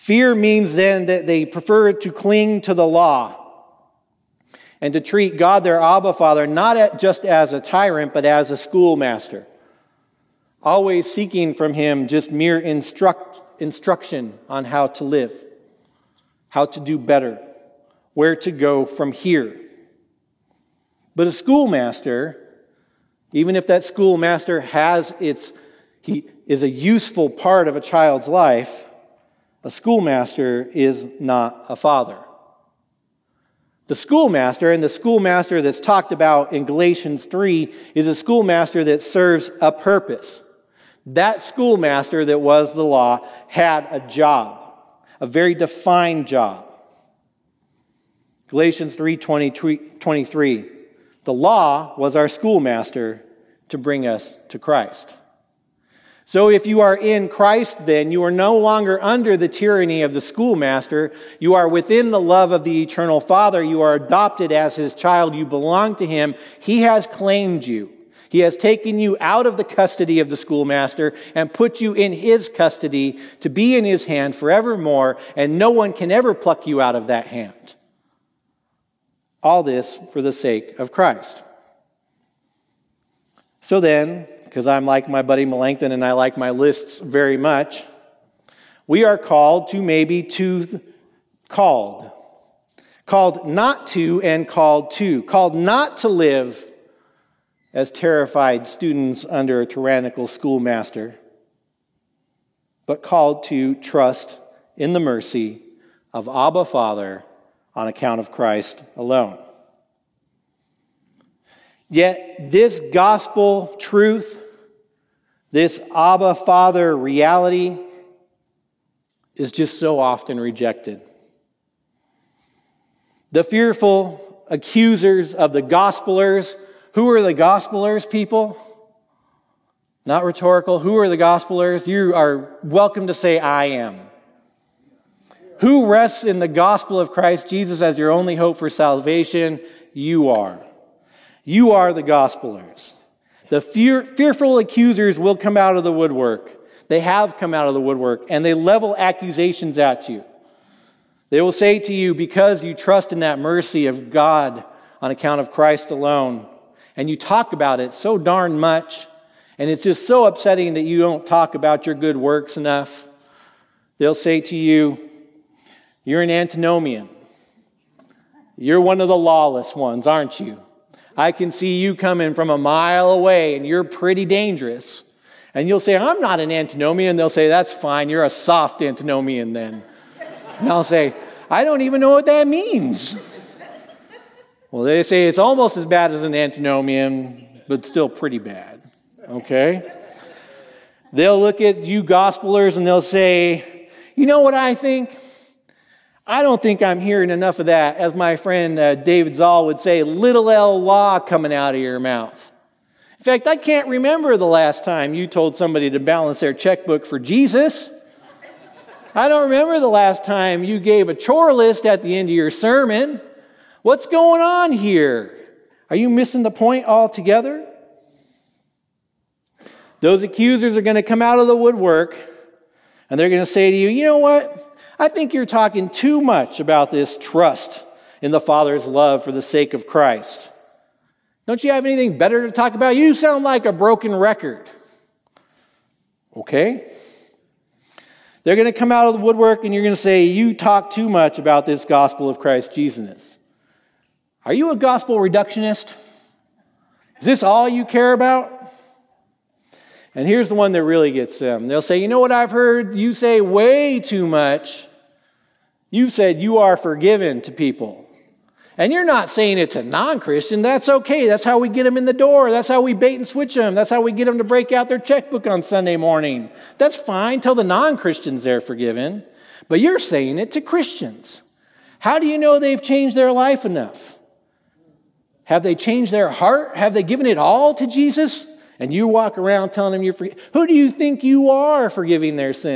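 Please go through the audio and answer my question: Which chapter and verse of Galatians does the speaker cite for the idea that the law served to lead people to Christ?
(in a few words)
Galatians 3:23.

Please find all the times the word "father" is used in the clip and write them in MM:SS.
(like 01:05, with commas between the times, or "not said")
00:06, 00:31, 01:03, 01:46, 01:56, 03:48.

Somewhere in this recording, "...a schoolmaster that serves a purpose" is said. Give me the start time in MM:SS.
00:38.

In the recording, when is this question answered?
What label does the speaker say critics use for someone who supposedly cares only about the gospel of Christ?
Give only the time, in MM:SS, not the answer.
04:04.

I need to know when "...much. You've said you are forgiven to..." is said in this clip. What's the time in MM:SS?
04:14.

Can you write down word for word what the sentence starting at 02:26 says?
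They have come out of the woodwork and they level accusations at you.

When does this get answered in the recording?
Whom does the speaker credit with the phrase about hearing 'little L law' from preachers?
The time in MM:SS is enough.
03:18.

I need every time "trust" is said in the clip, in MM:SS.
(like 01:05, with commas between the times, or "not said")
01:43, 02:32, 03:47.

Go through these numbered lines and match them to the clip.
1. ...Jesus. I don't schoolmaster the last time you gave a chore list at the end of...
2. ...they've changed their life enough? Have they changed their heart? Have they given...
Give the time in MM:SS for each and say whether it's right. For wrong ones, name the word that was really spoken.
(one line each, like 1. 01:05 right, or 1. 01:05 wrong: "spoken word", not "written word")
1. 03:27 wrong: "remember", not "schoolmaster"
2. 04:32 right.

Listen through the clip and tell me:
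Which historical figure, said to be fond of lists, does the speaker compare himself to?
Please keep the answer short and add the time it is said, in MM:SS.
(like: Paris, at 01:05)
Melanchthon, at 01:25.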